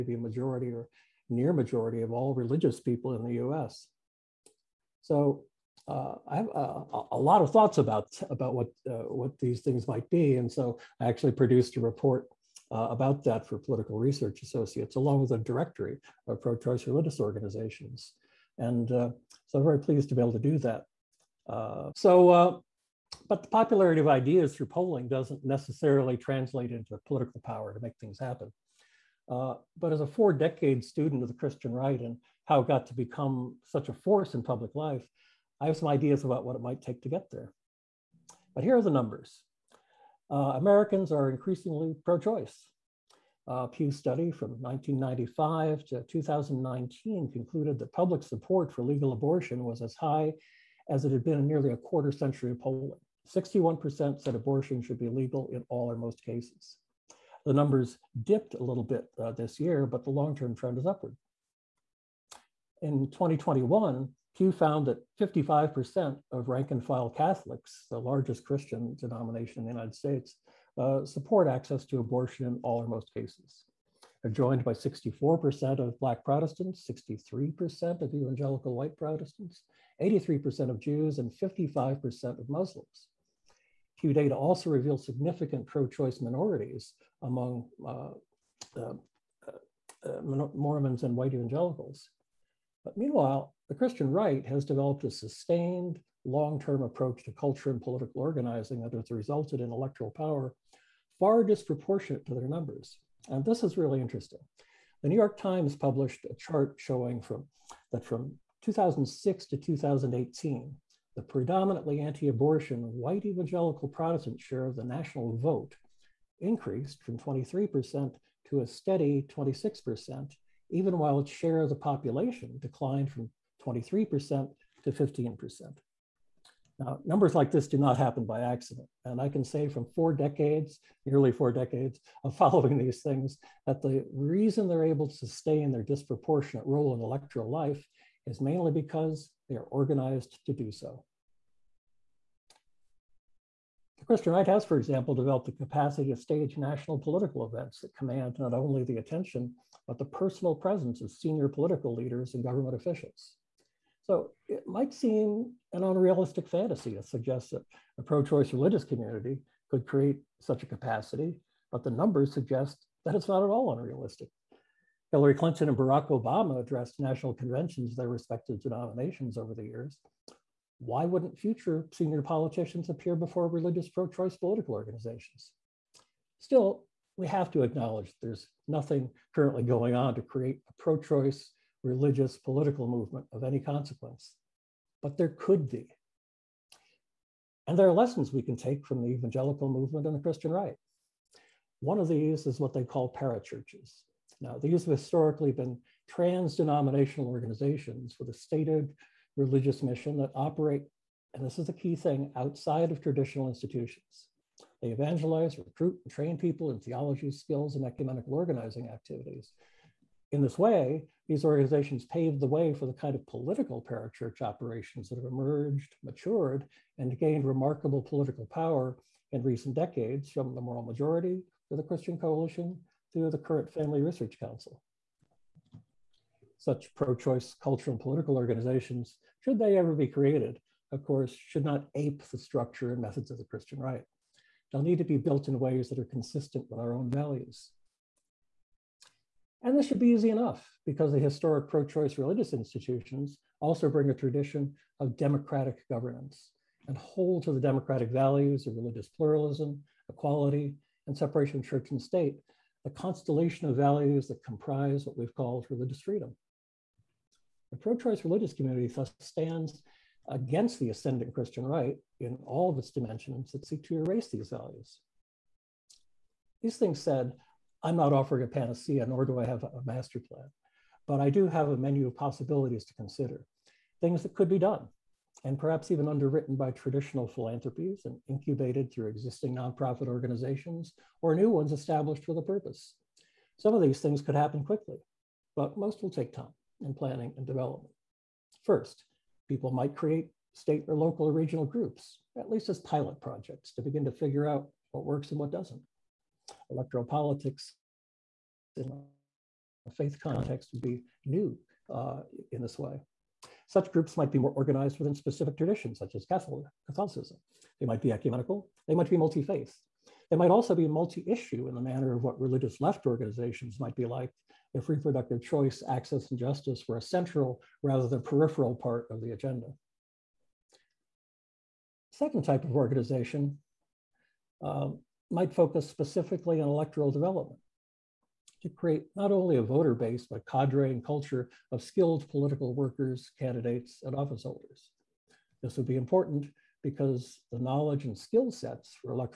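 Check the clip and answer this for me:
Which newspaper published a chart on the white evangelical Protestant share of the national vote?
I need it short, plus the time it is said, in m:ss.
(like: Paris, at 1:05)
The New York Times, at 1:45.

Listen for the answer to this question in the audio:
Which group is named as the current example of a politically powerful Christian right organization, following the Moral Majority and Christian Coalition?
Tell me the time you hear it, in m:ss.
3:43.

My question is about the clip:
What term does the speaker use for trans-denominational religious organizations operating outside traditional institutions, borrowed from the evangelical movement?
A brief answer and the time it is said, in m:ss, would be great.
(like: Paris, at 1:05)
parachurches, at 3:13.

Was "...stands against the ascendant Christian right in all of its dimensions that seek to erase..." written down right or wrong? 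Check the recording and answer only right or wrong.
right.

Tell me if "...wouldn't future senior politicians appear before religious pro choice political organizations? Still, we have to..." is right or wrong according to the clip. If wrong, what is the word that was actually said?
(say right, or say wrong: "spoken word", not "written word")
right.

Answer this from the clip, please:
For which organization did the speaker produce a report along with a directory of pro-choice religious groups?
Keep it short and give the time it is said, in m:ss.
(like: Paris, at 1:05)
Political Research Associates, at 0:13.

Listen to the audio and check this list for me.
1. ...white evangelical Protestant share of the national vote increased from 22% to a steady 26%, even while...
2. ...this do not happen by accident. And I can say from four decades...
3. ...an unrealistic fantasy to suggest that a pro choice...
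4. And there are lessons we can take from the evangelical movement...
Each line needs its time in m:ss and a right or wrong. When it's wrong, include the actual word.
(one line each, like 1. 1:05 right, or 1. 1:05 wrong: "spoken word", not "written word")
1. 1:52 wrong: "23", not "22"
2. 2:07 right
3. 2:35 right
4. 3:07 right.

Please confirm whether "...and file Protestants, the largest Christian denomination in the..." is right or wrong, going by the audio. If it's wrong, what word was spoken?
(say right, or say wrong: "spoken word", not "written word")
wrong: "Catholics", not "Protestants".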